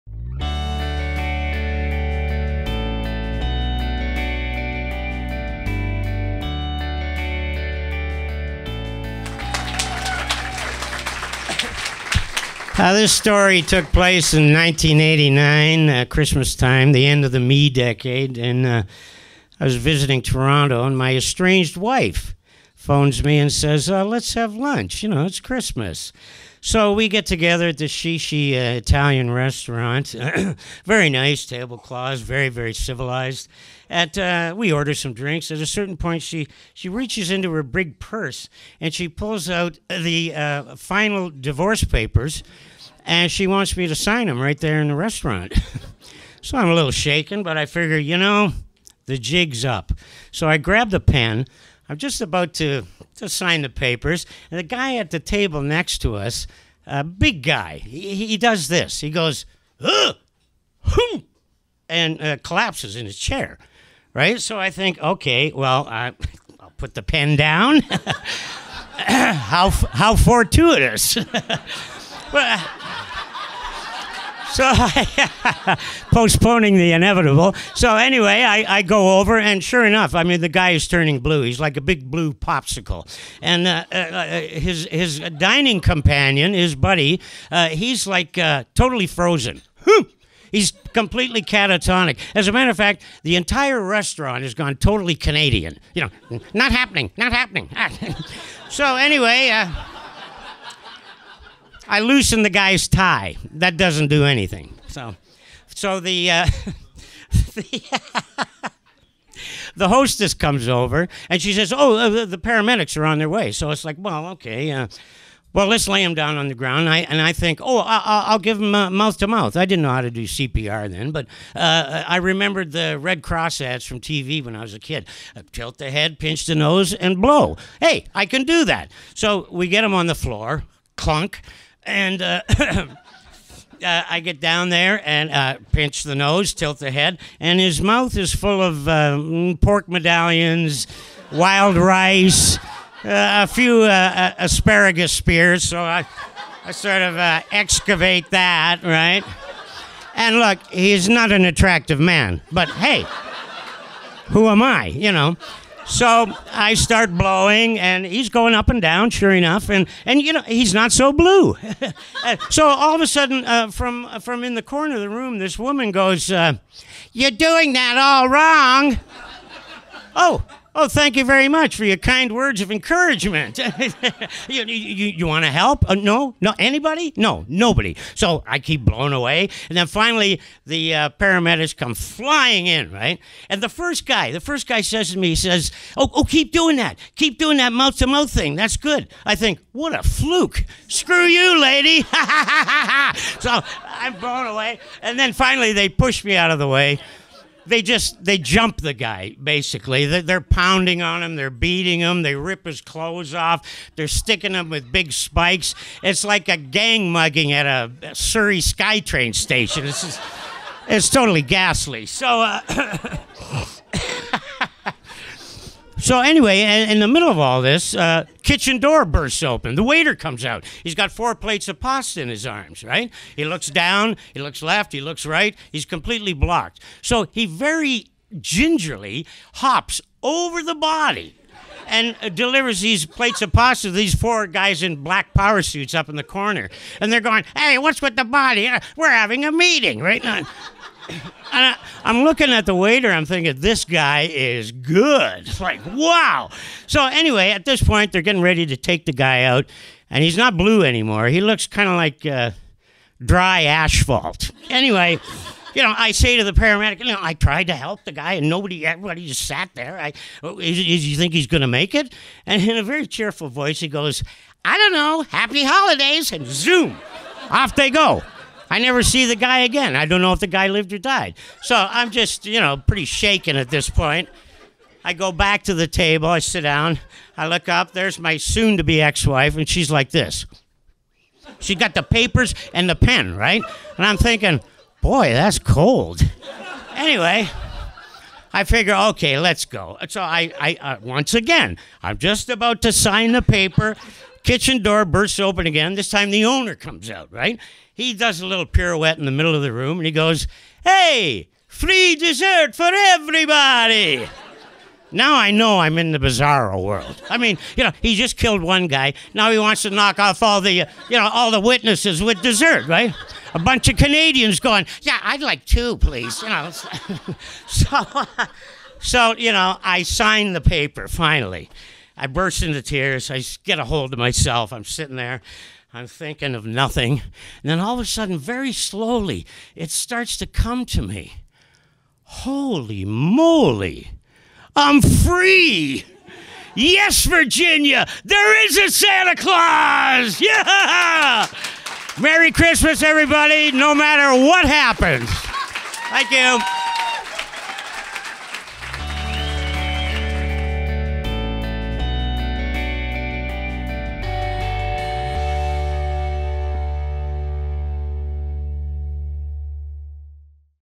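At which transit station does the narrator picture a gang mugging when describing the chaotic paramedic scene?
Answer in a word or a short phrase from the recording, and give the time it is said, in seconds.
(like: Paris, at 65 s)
Surrey SkyTrain station, at 208 s.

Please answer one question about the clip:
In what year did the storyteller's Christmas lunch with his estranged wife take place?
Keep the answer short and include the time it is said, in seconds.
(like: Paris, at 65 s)
1989, at 14 s.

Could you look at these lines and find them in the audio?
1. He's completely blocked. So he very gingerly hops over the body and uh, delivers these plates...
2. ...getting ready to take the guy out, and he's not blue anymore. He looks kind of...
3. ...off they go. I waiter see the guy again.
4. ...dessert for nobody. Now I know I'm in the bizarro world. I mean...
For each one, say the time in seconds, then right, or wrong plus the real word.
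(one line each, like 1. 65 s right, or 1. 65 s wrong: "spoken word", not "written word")
1. 225 s right
2. 248 s right
3. 267 s wrong: "never", not "waiter"
4. 302 s wrong: "everybody", not "nobody".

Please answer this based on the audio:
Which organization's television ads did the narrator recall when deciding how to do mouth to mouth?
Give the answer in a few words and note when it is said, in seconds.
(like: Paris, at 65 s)
Red Cross, at 122 s.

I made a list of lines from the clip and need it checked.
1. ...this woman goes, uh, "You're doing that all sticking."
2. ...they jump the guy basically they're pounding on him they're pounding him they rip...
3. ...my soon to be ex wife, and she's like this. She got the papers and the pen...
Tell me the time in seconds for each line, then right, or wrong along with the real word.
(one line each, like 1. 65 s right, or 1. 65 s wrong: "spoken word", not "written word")
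1. 165 s wrong: "wrong", not "sticking"
2. 198 s wrong: "beating", not "pounding"
3. 278 s right.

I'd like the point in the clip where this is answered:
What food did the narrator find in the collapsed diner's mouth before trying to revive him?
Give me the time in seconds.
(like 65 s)
139 s.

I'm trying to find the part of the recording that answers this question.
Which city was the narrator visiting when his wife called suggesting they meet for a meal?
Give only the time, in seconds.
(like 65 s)
20 s.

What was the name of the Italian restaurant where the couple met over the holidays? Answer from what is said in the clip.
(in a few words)
Shishi.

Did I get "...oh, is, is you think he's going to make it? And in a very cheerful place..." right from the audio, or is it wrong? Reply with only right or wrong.
wrong.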